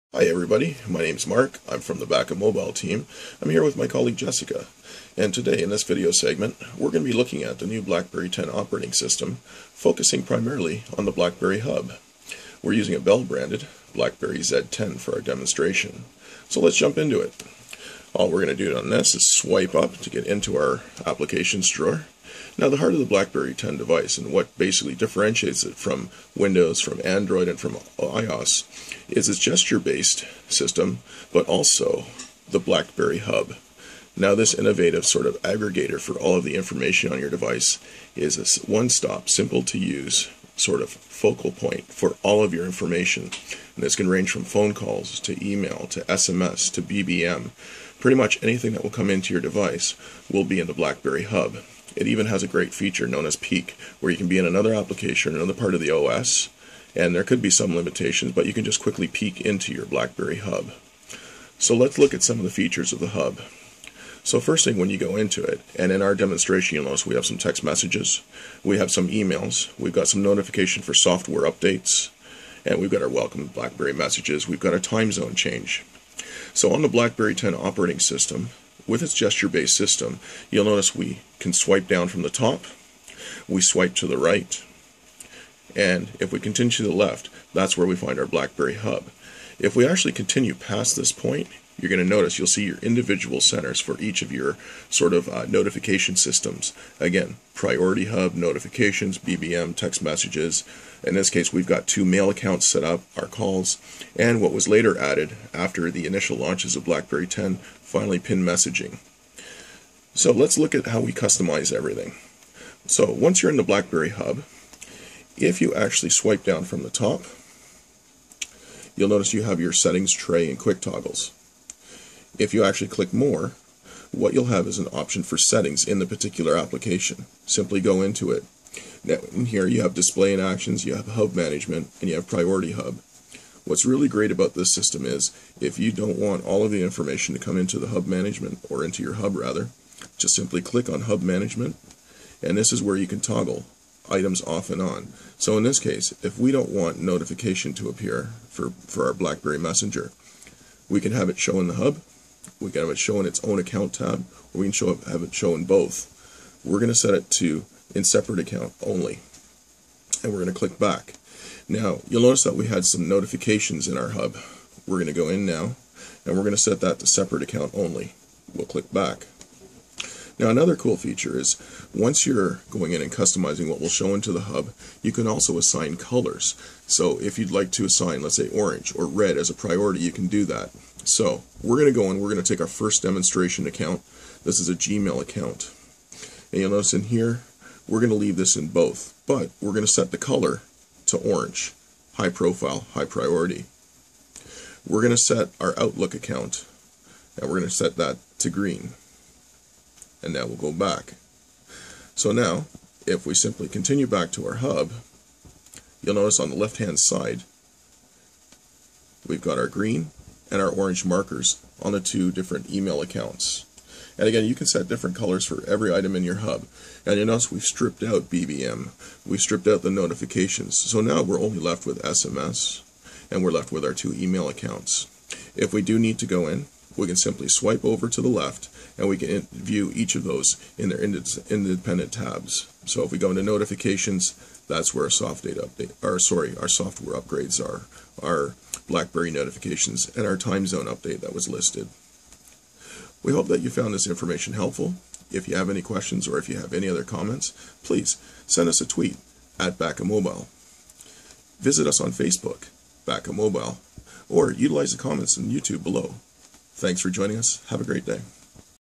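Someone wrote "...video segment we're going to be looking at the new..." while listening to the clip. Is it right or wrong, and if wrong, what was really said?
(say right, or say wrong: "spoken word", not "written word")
right.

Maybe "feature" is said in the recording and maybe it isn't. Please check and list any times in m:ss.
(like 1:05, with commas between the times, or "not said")
0:52, 1:02, 2:50.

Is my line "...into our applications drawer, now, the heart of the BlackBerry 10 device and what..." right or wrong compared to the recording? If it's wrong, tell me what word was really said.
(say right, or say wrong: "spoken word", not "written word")
right.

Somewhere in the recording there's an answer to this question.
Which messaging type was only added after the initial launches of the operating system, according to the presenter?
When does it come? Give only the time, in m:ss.
1:48.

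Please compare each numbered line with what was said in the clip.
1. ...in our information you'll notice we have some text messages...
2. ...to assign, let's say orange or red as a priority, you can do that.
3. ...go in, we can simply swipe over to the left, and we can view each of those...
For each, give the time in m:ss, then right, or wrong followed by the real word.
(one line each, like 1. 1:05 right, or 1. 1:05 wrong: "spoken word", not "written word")
1. 1:05 wrong: "demonstration", not "information"
2. 2:57 right
3. 3:46 right.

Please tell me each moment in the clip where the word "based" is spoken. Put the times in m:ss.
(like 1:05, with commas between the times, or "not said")
0:29, 1:19.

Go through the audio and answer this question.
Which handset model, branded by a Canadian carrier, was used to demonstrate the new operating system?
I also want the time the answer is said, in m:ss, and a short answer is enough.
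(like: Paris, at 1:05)
BlackBerry Z10, at 0:13.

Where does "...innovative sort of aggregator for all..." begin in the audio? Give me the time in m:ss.
0:34.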